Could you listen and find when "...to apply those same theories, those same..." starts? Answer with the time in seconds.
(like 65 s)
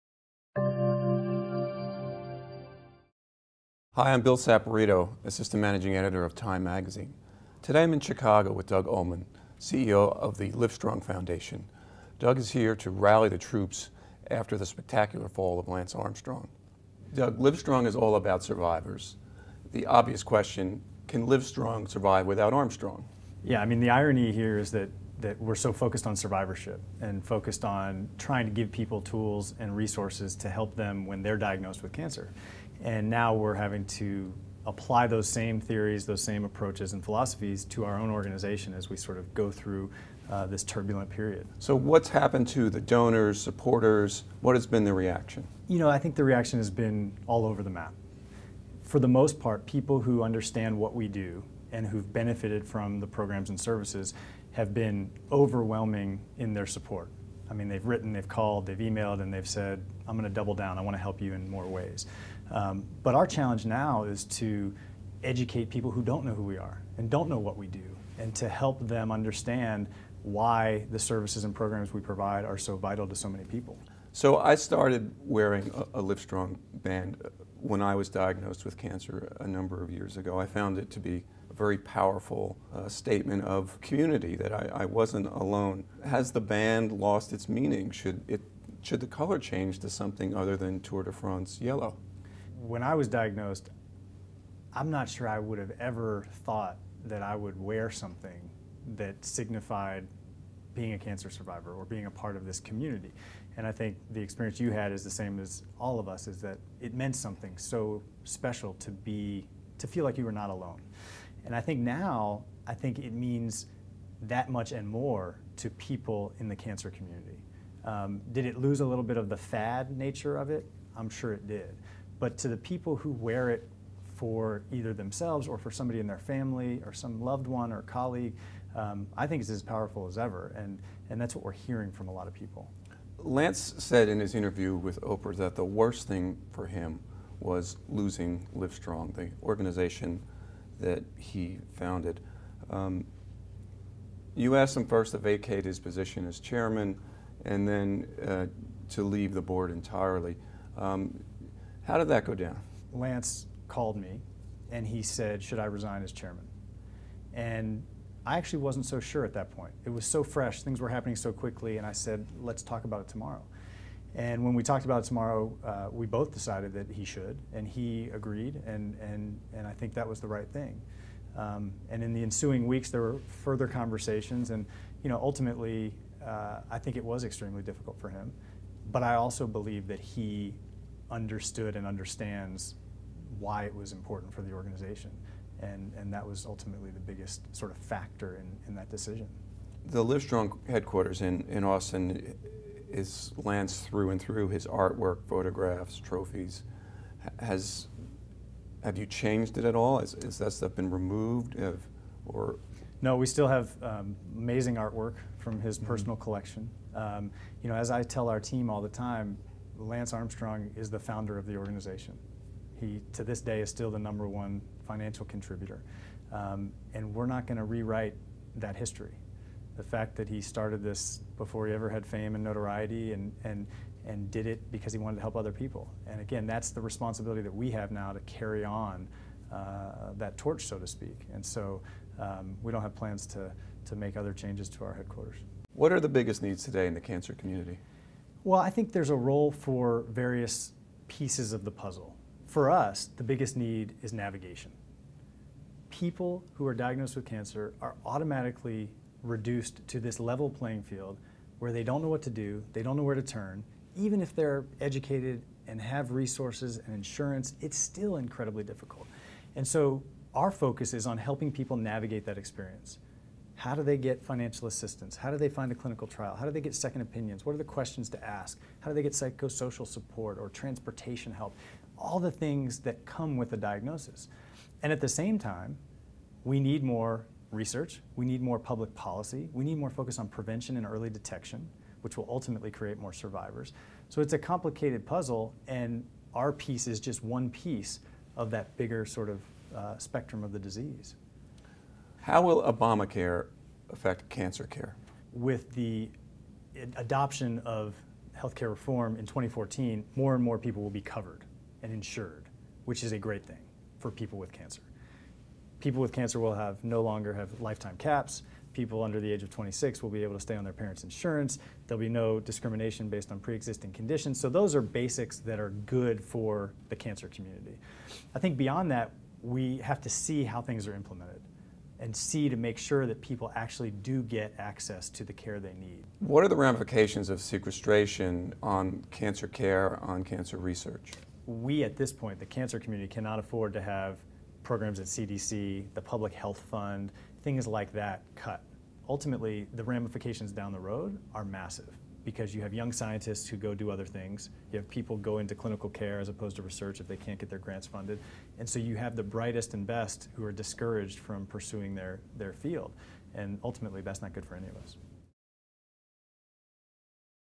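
33 s.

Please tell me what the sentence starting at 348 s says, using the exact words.
And so you have the brightest and best who are discouraged from pursuing their, their field.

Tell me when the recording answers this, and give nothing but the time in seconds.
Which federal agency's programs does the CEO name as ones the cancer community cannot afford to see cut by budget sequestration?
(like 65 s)
335 s.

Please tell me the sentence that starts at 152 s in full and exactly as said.
Lance called me and he said, Should I resign as chairman?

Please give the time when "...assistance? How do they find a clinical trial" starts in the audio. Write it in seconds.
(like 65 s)
264 s.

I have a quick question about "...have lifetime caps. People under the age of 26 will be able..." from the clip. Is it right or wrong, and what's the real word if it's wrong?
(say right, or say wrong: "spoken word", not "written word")
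right.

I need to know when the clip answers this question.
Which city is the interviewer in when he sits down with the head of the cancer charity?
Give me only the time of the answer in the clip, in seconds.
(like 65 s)
7 s.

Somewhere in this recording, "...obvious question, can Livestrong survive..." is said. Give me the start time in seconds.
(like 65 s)
19 s.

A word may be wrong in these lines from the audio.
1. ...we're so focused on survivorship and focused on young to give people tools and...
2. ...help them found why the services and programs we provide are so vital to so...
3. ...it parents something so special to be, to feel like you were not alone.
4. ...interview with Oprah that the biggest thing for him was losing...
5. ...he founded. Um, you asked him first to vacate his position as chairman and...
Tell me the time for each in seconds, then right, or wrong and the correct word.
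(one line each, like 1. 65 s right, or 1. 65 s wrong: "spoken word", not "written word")
1. 25 s wrong: "trying", not "young"
2. 68 s wrong: "understand", not "found"
3. 106 s wrong: "meant", not "parents"
4. 134 s wrong: "worst", not "biggest"
5. 141 s right.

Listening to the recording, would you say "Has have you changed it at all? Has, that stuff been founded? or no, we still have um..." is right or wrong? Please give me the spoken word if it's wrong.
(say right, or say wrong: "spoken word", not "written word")
wrong: "removed", not "founded".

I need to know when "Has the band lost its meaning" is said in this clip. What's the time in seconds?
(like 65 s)
86 s.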